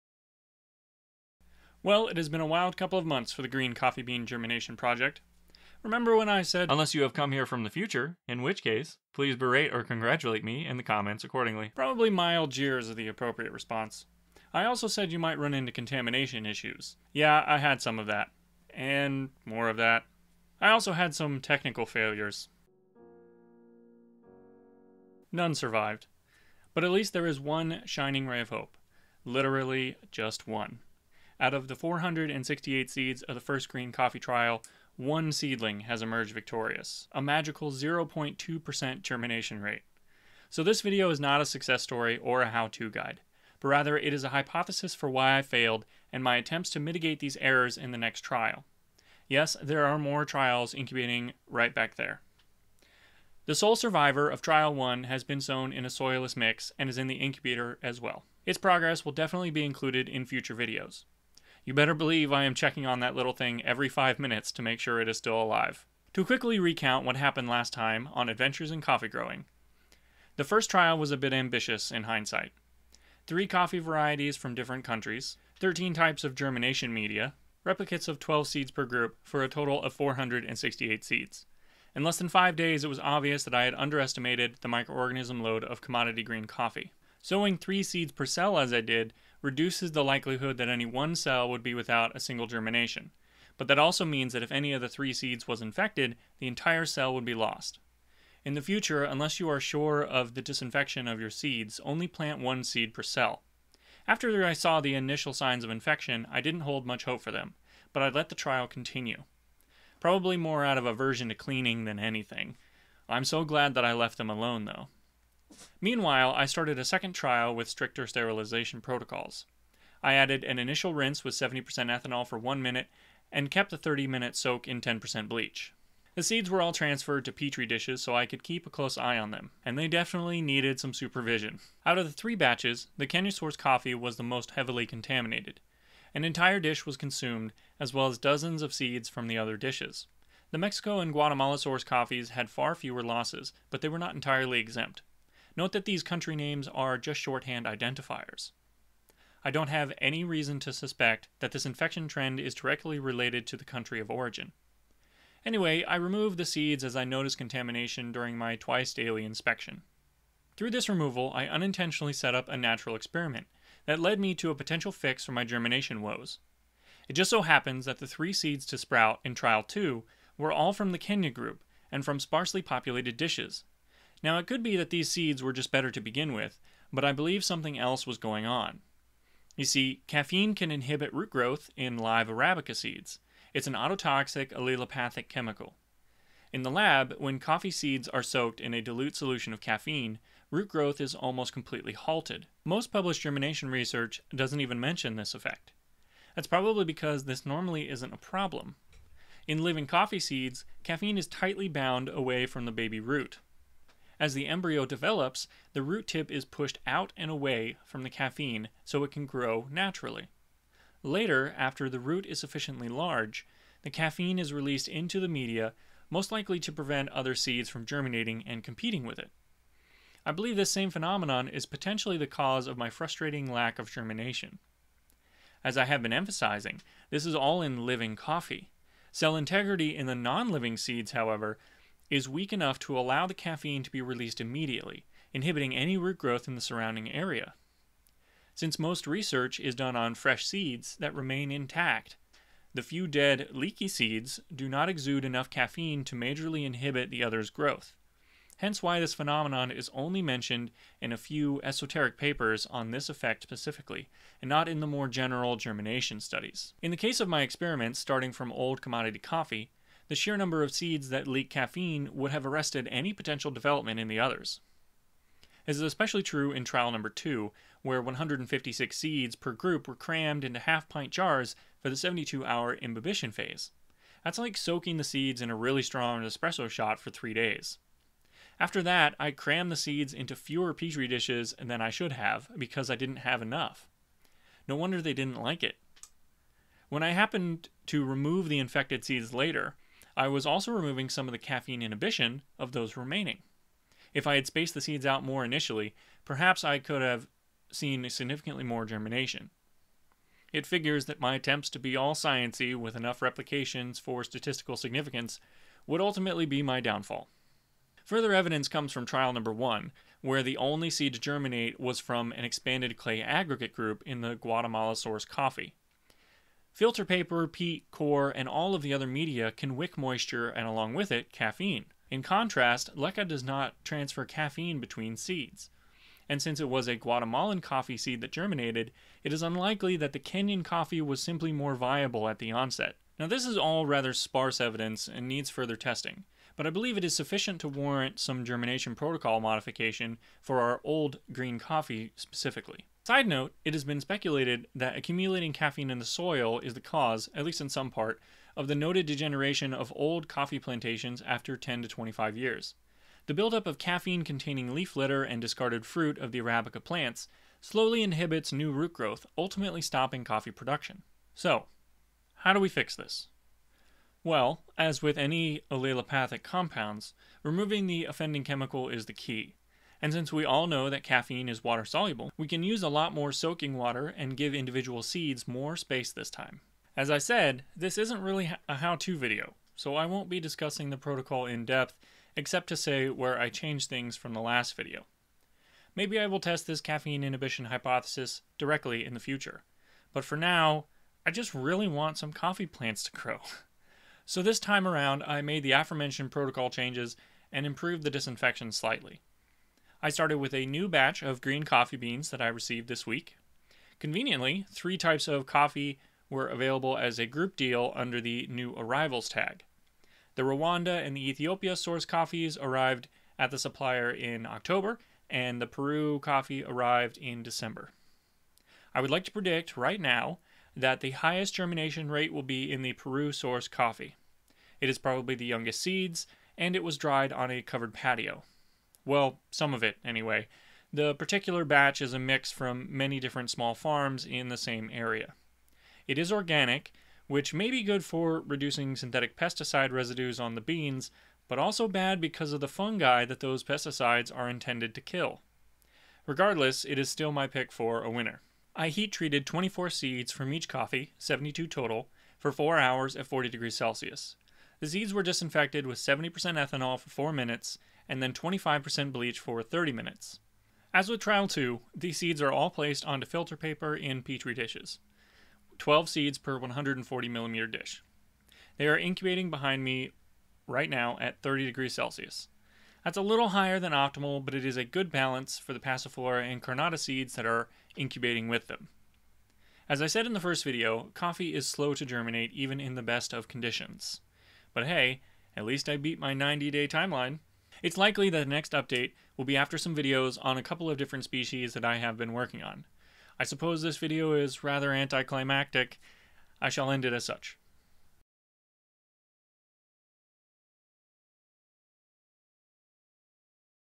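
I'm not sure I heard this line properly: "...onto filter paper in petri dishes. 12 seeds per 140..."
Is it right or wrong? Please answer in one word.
right.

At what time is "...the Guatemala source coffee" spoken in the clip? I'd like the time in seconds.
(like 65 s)
314 s.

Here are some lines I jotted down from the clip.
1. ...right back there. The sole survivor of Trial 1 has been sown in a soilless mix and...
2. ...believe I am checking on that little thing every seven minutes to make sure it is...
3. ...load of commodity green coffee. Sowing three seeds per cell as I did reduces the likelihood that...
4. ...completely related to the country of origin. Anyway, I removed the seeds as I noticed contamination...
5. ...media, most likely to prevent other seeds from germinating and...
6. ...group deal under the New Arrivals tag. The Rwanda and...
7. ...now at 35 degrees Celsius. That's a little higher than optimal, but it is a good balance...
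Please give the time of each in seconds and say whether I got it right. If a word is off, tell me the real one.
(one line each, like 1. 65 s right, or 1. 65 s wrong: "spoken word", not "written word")
1. 51 s right
2. 61 s wrong: "five", not "seven"
3. 85 s right
4. 152 s wrong: "directly", not "completely"
5. 215 s right
6. 407 s right
7. 470 s wrong: "30", not "35".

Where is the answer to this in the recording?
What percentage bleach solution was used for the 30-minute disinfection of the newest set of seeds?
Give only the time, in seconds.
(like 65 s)
458 s.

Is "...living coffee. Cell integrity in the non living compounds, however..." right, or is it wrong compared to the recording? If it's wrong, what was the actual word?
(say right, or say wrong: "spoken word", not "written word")
wrong: "seeds", not "compounds".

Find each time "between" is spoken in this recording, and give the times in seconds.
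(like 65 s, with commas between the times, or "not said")
324 s.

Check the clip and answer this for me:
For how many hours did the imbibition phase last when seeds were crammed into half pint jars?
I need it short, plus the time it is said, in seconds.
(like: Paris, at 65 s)
72 hours, at 271 s.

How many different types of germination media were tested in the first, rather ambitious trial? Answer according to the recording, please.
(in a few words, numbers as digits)
13.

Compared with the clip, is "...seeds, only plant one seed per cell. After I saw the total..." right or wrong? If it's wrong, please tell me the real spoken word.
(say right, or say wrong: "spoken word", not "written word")
wrong: "initial", not "total".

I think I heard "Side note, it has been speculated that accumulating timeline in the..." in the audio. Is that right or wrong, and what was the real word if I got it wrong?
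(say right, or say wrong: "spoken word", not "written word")
wrong: "caffeine", not "timeline".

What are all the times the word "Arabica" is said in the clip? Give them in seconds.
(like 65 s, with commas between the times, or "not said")
182 s, 356 s.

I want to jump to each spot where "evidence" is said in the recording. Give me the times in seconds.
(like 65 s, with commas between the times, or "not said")
308 s, 334 s.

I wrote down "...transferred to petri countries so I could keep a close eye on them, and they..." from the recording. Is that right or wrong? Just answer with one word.
wrong.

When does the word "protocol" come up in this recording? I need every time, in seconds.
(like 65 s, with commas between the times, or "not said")
118 s, 338 s, 380 s, 396 s.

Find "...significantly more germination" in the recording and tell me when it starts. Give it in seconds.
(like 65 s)
298 s.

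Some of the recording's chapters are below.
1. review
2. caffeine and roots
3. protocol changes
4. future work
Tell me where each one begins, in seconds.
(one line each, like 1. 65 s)
1. 66 s
2. 179 s
3. 361 s
4. 479 s.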